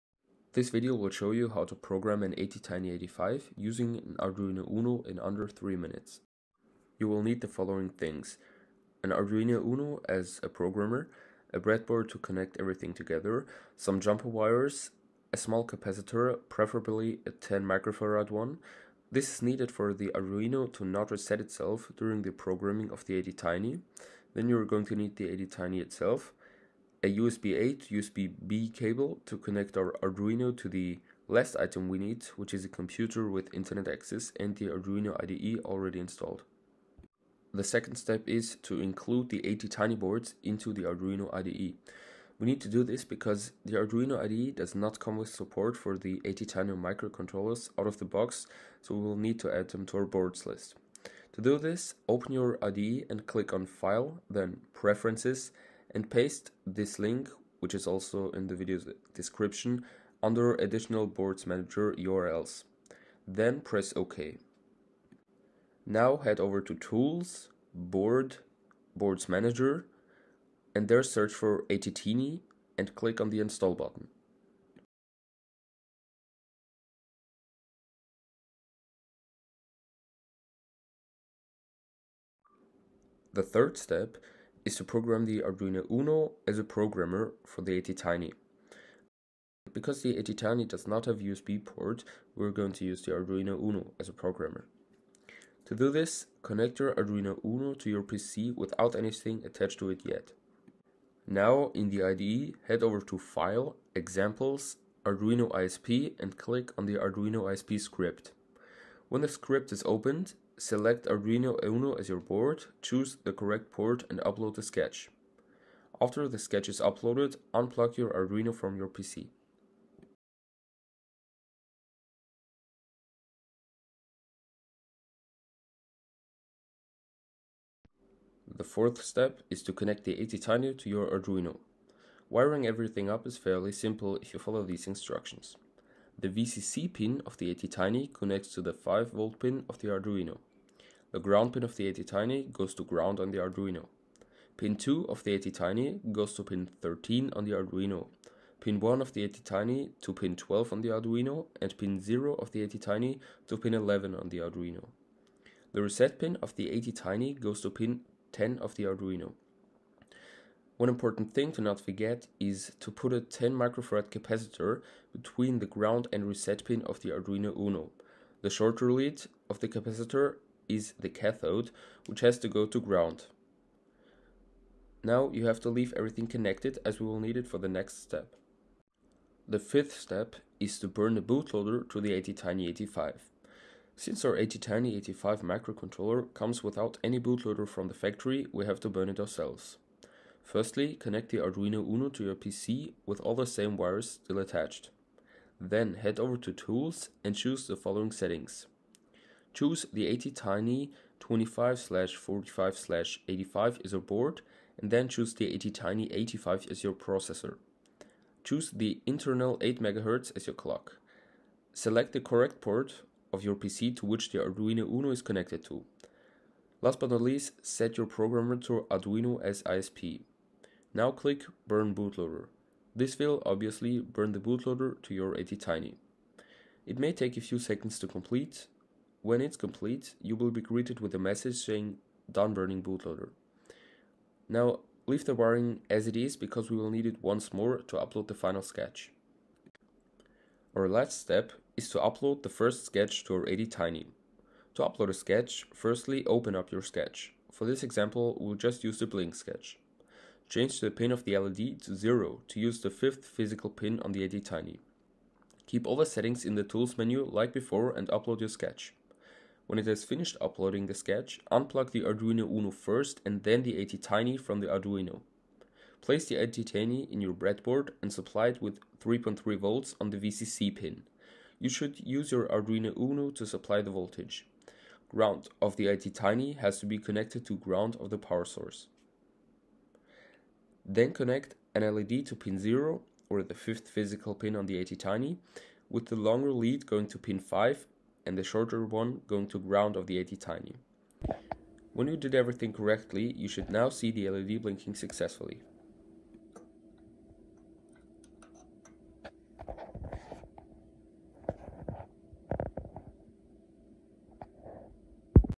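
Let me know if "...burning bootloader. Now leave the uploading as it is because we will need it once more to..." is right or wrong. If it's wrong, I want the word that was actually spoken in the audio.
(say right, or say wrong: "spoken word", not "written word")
wrong: "wiring", not "uploading".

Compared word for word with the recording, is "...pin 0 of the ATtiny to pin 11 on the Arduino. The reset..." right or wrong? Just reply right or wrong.
right.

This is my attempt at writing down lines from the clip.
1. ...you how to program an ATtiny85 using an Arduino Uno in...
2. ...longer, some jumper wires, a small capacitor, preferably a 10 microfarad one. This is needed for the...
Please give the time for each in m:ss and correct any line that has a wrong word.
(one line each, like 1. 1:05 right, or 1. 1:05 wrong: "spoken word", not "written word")
1. 0:01 right
2. 0:12 wrong: "together", not "longer".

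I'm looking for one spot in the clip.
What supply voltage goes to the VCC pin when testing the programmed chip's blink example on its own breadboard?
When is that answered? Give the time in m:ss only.
4:29.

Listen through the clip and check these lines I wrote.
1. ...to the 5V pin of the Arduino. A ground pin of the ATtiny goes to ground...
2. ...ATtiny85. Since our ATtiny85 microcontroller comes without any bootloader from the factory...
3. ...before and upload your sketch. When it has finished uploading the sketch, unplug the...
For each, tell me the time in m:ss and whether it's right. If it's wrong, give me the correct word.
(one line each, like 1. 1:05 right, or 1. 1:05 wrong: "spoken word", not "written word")
1. 2:18 right
2. 3:02 right
3. 4:17 right.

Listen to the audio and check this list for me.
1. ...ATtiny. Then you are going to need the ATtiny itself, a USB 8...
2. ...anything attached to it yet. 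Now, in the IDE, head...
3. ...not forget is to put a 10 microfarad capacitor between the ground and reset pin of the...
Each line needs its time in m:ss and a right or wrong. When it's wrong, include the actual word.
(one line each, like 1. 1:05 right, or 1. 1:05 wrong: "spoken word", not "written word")
1. 0:23 right
2. 1:38 right
3. 2:41 right.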